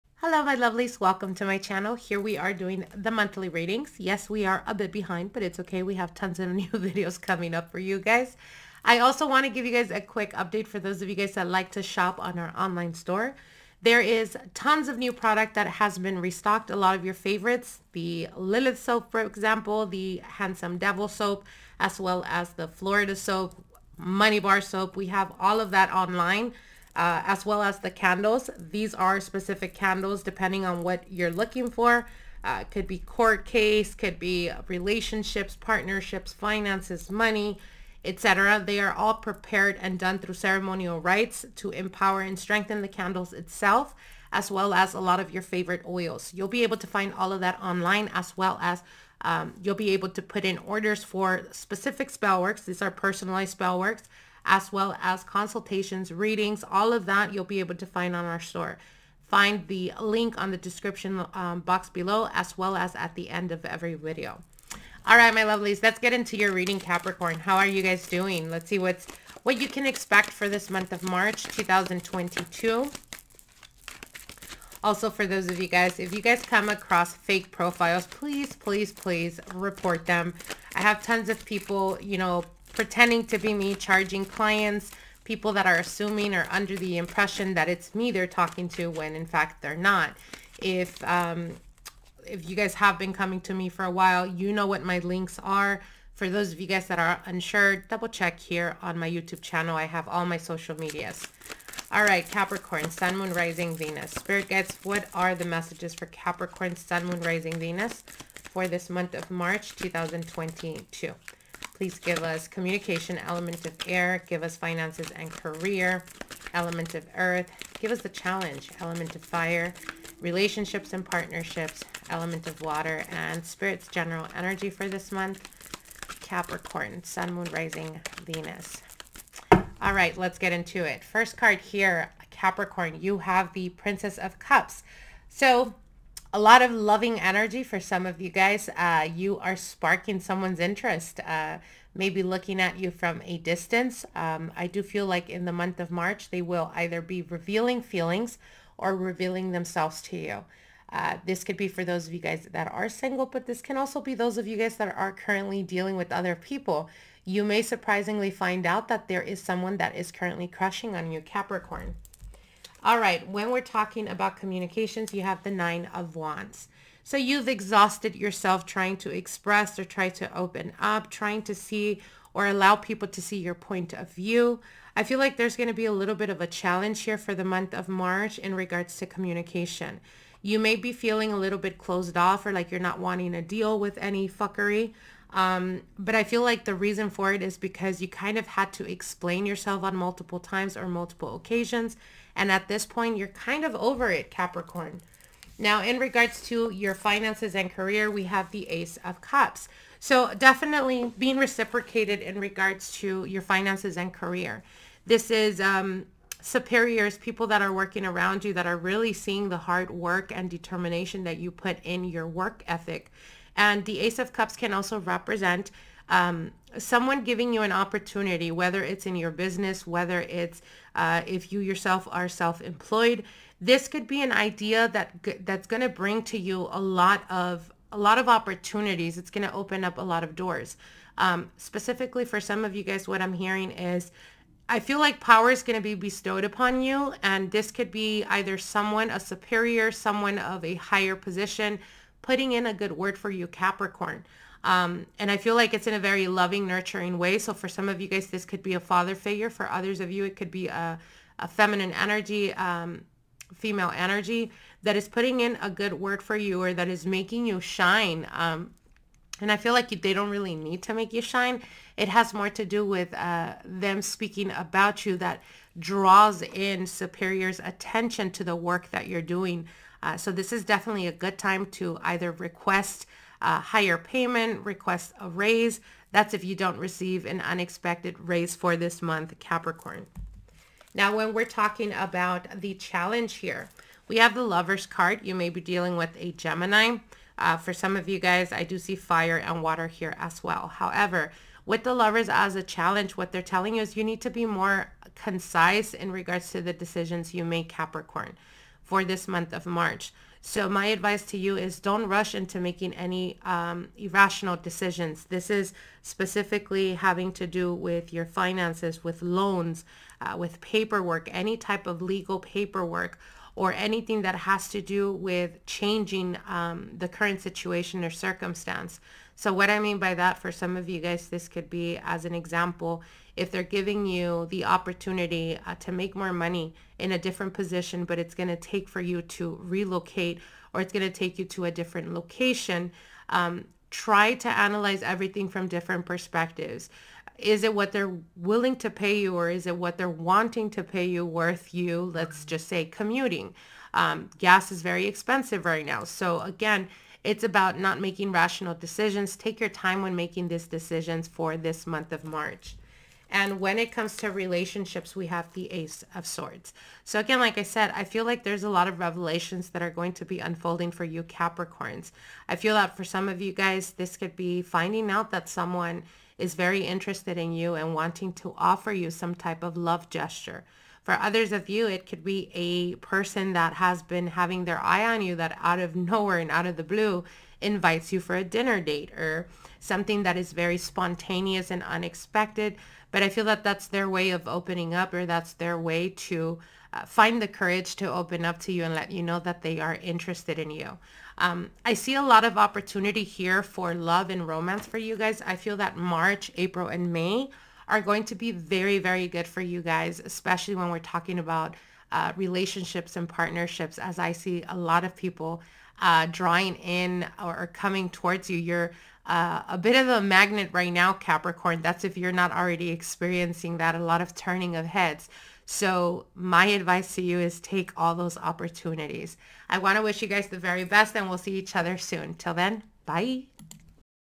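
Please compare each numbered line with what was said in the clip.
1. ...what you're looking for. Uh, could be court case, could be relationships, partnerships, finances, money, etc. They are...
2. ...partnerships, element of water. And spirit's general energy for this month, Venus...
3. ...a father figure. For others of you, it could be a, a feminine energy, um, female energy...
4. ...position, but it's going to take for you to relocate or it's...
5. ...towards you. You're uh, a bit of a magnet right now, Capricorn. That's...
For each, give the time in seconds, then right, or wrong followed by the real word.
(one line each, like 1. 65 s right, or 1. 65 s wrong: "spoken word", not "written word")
1. 30 s right
2. 121 s wrong: "Capricorn", not "Venus"
3. 248 s right
4. 327 s right
5. 408 s right.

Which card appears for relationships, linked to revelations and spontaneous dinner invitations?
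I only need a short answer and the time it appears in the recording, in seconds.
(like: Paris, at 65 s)
Ace of Swords, at 355 s.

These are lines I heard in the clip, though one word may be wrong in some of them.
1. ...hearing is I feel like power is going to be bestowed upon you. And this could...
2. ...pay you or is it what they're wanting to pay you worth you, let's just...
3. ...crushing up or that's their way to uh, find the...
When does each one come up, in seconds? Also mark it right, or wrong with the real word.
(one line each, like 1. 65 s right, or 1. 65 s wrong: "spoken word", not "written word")
1. 233 s right
2. 338 s right
3. 384 s wrong: "opening", not "crushing".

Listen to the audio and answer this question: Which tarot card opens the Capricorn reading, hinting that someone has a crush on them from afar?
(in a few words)
Princess of Cups.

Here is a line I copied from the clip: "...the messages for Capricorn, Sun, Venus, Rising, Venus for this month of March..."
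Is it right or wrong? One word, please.
wrong.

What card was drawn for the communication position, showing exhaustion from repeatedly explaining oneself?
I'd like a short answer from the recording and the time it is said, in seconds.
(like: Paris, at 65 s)
Nine of Wands, at 165 s.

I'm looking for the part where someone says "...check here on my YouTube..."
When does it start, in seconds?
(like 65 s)
98 s.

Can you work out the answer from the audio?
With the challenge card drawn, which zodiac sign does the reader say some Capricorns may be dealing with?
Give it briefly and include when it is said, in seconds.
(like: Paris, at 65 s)
Gemini, at 286 s.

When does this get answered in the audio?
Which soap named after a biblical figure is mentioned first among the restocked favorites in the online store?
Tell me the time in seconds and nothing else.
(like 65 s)
18 s.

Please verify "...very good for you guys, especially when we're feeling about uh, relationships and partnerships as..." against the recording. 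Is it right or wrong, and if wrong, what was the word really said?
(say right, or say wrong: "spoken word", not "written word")
wrong: "talking", not "feeling".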